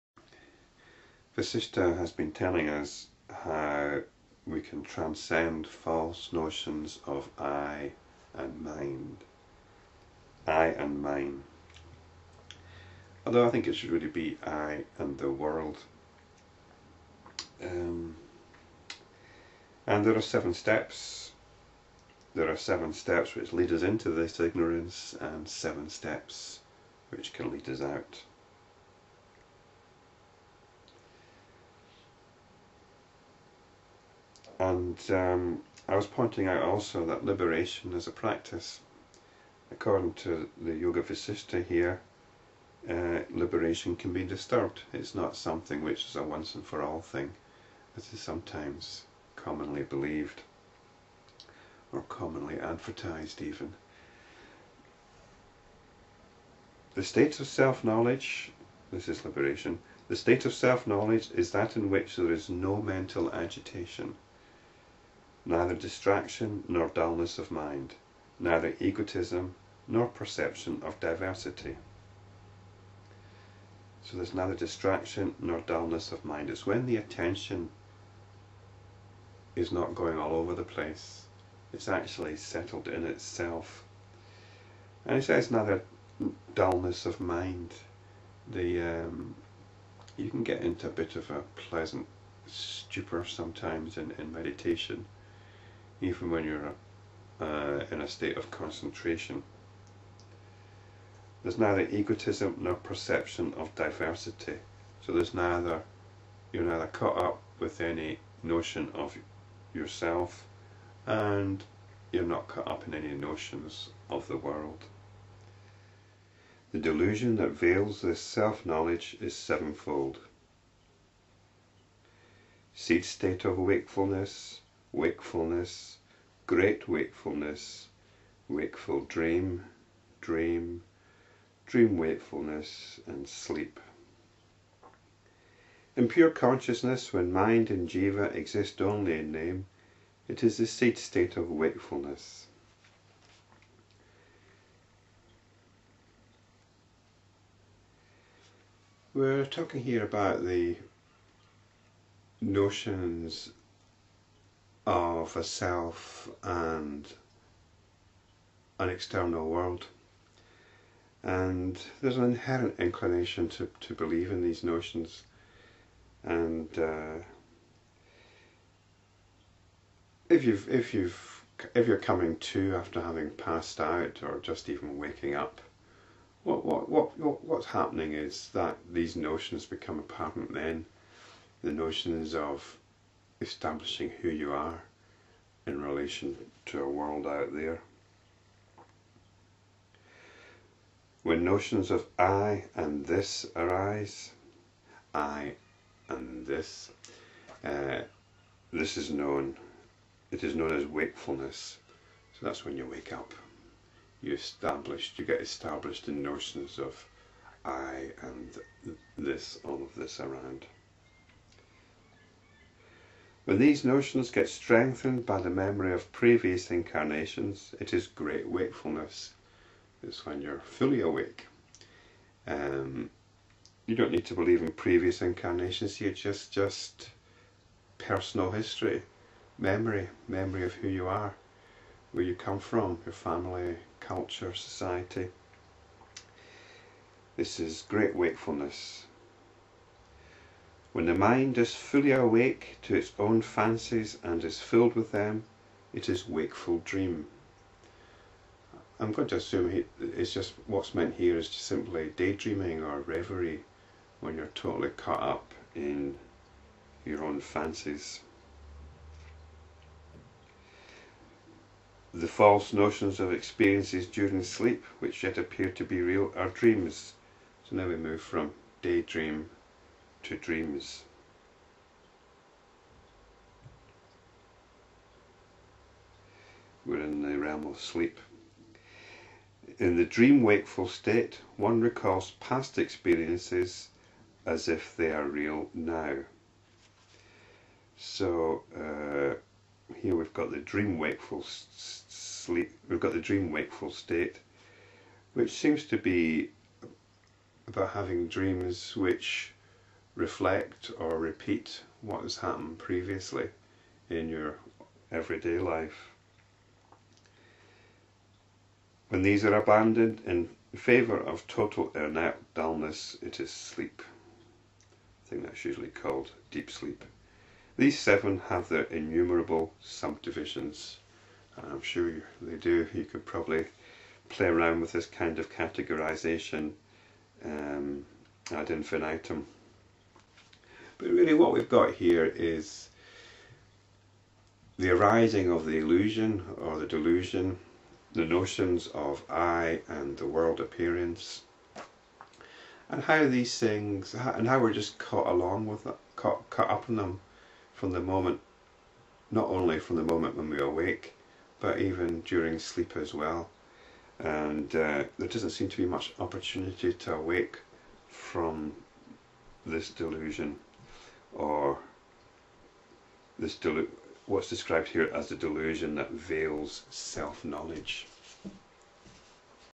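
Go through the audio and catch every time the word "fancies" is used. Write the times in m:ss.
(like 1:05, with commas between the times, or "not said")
4:03, 4:17.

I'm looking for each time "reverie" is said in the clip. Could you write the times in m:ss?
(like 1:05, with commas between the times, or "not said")
4:12.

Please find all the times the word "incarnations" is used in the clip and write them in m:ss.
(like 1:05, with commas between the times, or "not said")
3:36, 3:45.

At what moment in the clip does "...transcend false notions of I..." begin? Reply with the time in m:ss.
0:04.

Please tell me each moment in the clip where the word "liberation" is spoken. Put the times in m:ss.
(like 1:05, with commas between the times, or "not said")
0:37, 0:43, 0:59.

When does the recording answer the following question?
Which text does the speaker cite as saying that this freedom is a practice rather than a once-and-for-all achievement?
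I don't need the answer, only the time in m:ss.
0:40.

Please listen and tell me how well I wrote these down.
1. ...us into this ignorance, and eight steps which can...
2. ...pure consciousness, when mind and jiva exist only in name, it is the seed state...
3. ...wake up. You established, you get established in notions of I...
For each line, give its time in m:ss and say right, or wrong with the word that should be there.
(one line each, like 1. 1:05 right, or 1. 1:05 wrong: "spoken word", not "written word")
1. 0:23 wrong: "seven", not "eight"
2. 2:16 right
3. 3:22 right.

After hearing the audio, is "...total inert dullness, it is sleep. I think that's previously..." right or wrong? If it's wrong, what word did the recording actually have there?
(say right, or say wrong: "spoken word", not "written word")
wrong: "usually", not "previously".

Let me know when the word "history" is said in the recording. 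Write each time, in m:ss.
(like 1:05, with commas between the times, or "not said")
3:48.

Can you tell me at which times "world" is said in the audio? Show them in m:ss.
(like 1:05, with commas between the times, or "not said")
0:15, 1:54, 2:39, 3:06, 5:40.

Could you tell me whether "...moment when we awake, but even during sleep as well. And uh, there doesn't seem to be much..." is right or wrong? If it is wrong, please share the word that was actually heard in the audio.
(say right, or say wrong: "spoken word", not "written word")
right.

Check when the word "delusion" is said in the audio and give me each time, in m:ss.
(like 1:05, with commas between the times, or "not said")
1:56, 5:36, 5:59, 6:05.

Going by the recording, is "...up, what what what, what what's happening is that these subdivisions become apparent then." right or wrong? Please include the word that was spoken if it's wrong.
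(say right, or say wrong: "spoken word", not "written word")
wrong: "notions", not "subdivisions".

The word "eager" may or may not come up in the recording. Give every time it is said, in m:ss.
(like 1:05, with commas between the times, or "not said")
not said.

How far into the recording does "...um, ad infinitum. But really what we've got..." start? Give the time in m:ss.
5:27.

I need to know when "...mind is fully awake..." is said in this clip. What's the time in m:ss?
4:01.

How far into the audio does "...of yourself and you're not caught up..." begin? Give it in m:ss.
1:48.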